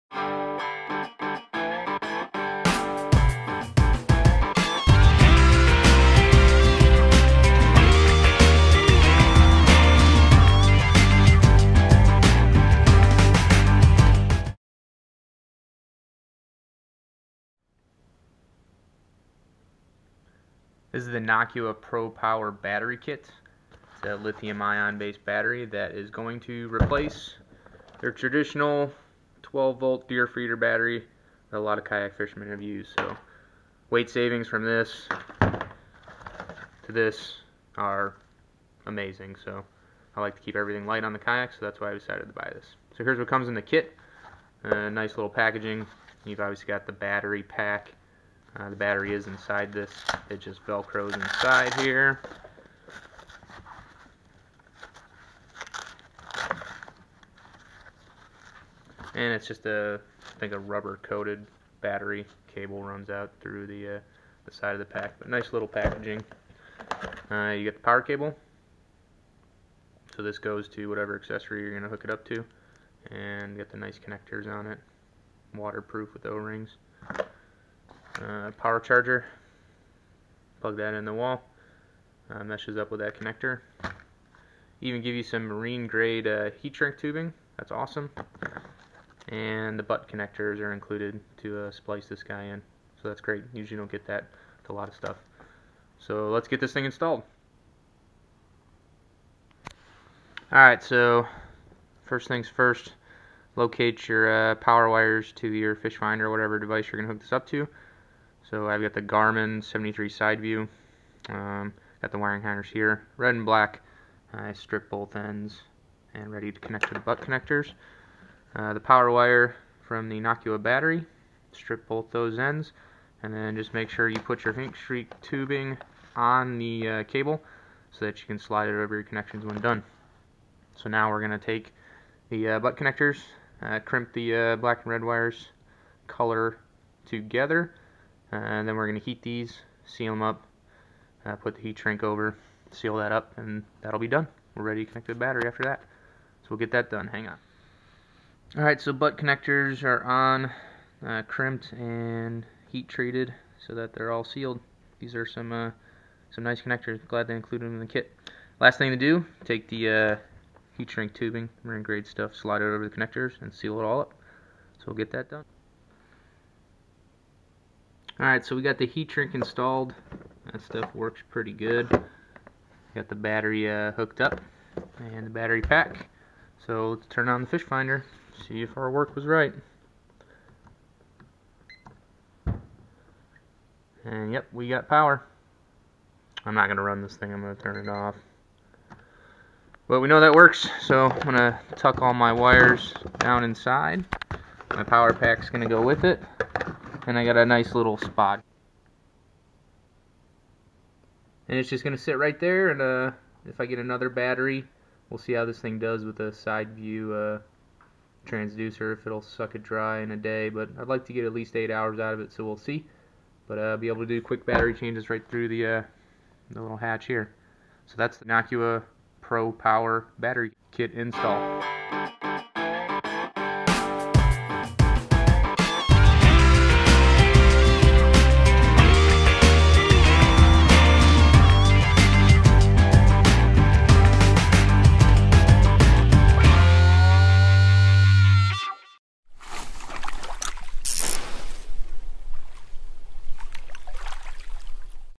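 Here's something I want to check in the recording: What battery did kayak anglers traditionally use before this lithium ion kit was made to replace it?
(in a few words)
12 volt deer feeder battery.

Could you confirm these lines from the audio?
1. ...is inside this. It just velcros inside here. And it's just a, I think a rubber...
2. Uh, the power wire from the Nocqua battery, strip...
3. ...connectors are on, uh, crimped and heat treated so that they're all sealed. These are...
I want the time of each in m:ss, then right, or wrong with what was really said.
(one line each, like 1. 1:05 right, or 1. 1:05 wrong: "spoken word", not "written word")
1. 0:49 right
2. 1:58 right
3. 2:29 right.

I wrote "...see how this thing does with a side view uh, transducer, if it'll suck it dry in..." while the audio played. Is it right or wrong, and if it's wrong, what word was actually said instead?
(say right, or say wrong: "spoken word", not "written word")
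right.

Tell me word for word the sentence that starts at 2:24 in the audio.
We're ready to connect the battery after that.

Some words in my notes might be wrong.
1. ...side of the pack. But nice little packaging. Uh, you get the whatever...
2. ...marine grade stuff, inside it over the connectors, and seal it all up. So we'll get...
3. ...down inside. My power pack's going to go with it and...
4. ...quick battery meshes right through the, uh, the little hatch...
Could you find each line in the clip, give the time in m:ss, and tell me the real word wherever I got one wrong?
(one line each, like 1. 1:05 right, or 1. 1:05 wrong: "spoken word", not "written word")
1. 1:04 wrong: "power", not "whatever"
2. 2:41 wrong: "slide", not "inside"
3. 3:13 right
4. 3:34 wrong: "changes", not "meshes".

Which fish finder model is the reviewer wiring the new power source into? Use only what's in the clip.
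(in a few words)
Garmin 73 side view.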